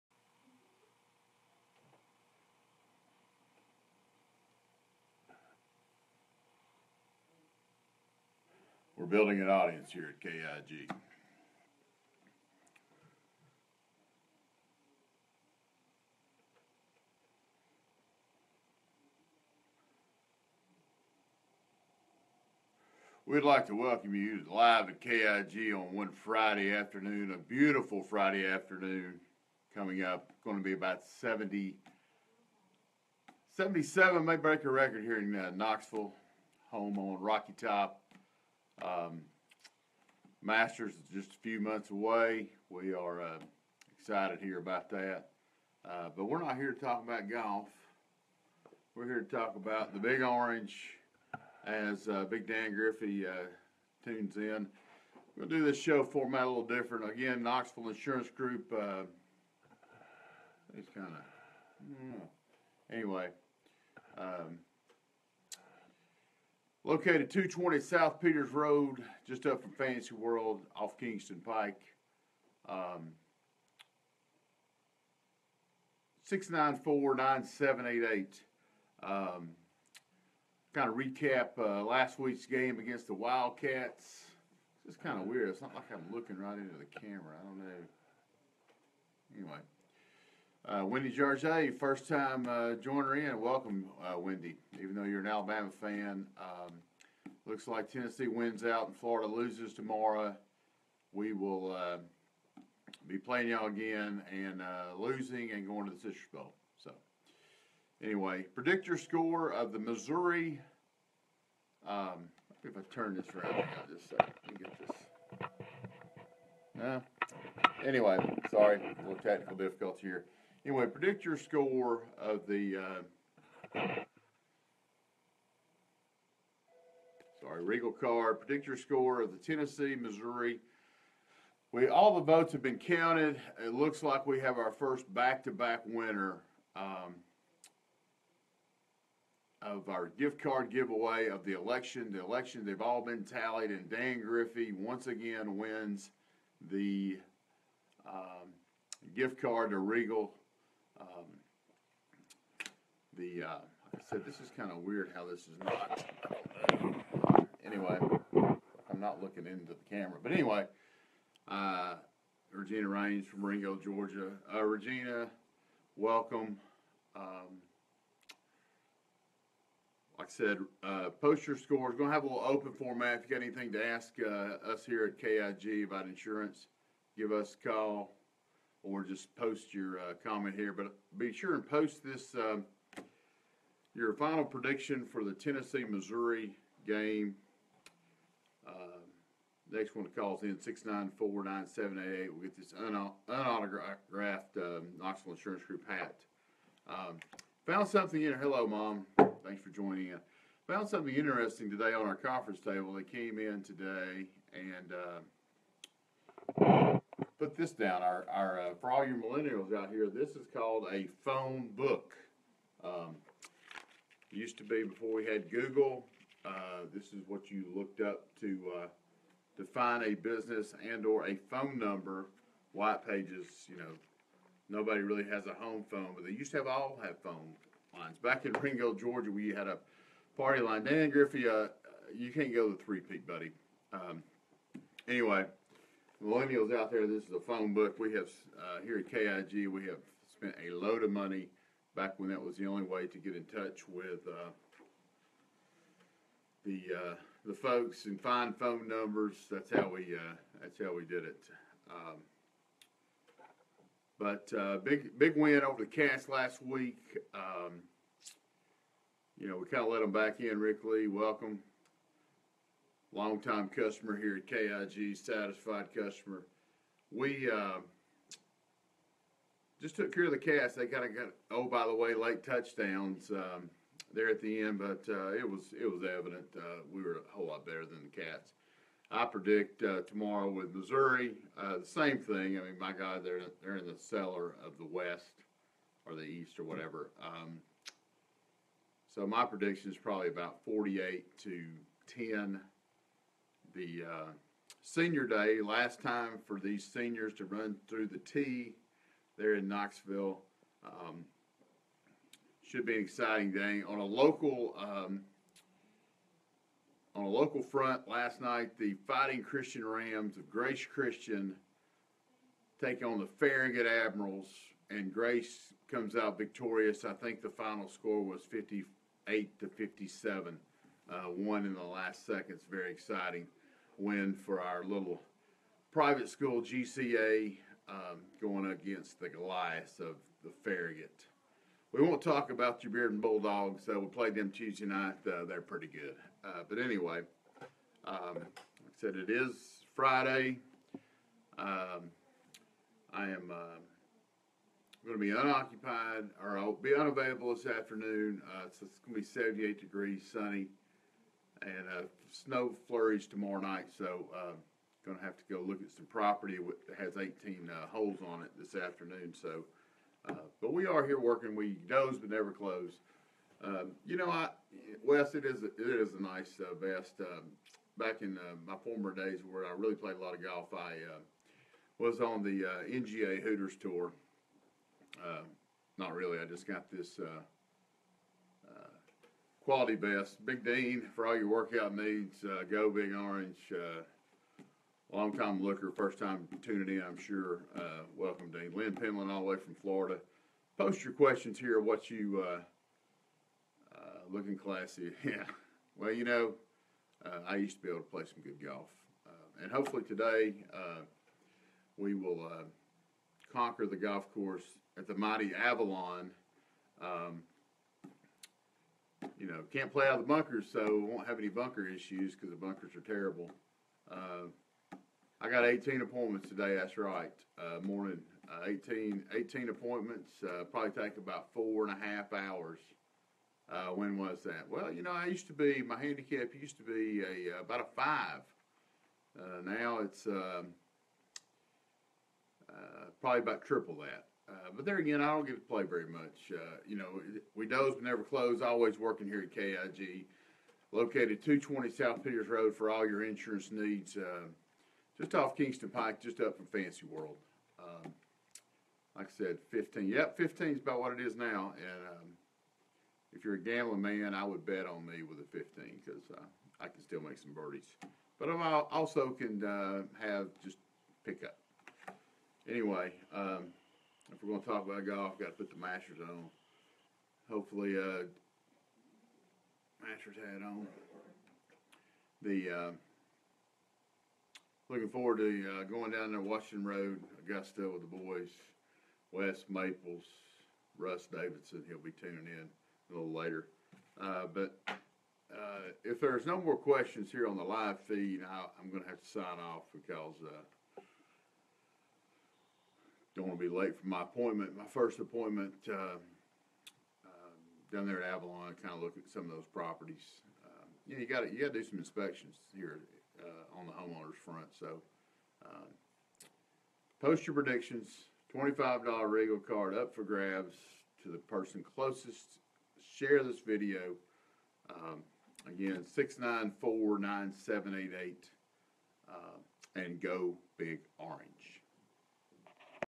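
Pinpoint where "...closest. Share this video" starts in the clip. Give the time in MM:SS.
08:31.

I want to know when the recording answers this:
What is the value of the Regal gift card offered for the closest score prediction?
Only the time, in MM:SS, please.
08:28.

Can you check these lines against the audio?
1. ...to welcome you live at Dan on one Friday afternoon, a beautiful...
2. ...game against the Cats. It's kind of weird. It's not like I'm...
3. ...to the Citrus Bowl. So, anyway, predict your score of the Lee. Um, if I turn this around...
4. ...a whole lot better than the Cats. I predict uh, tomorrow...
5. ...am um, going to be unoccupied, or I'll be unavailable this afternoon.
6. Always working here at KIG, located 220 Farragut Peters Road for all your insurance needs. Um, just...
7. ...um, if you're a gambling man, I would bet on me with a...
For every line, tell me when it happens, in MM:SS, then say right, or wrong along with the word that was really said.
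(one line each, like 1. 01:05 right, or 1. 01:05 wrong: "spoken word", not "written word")
1. 00:23 wrong: "KIG", not "Dan"
2. 01:22 wrong: "Wildcats", not "Cats"
3. 01:45 wrong: "Missouri", not "Lee"
4. 04:37 right
5. 05:43 right
6. 07:18 wrong: "South", not "Farragut"
7. 07:32 right.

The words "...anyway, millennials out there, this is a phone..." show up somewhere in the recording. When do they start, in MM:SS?
03:55.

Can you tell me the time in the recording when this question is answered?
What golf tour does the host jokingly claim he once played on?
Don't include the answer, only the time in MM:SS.
06:12.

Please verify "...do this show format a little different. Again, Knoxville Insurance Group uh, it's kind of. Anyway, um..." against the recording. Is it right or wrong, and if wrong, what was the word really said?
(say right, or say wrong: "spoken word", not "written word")
right.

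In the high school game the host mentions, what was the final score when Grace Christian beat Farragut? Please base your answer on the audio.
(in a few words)
58 to 57.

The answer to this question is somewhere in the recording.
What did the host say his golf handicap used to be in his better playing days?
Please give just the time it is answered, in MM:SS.
07:08.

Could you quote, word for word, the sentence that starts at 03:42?
White pages, you know, nobody really has a home phone, but they used to have all have phone lines.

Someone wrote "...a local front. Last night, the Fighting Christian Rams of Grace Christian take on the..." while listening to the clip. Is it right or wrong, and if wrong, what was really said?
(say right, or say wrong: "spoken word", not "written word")
right.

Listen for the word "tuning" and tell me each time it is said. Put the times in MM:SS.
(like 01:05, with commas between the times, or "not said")
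06:26, 08:02.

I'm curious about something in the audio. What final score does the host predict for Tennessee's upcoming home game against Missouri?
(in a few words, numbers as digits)
48 to 10.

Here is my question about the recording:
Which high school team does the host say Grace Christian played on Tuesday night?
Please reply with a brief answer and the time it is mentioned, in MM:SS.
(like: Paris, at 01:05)
Bearden Bulldogs, at 05:32.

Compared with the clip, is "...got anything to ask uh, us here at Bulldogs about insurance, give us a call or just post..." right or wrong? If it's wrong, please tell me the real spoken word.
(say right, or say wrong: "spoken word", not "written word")
wrong: "KIG", not "Bulldogs".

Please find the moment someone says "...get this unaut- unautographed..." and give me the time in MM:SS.
03:12.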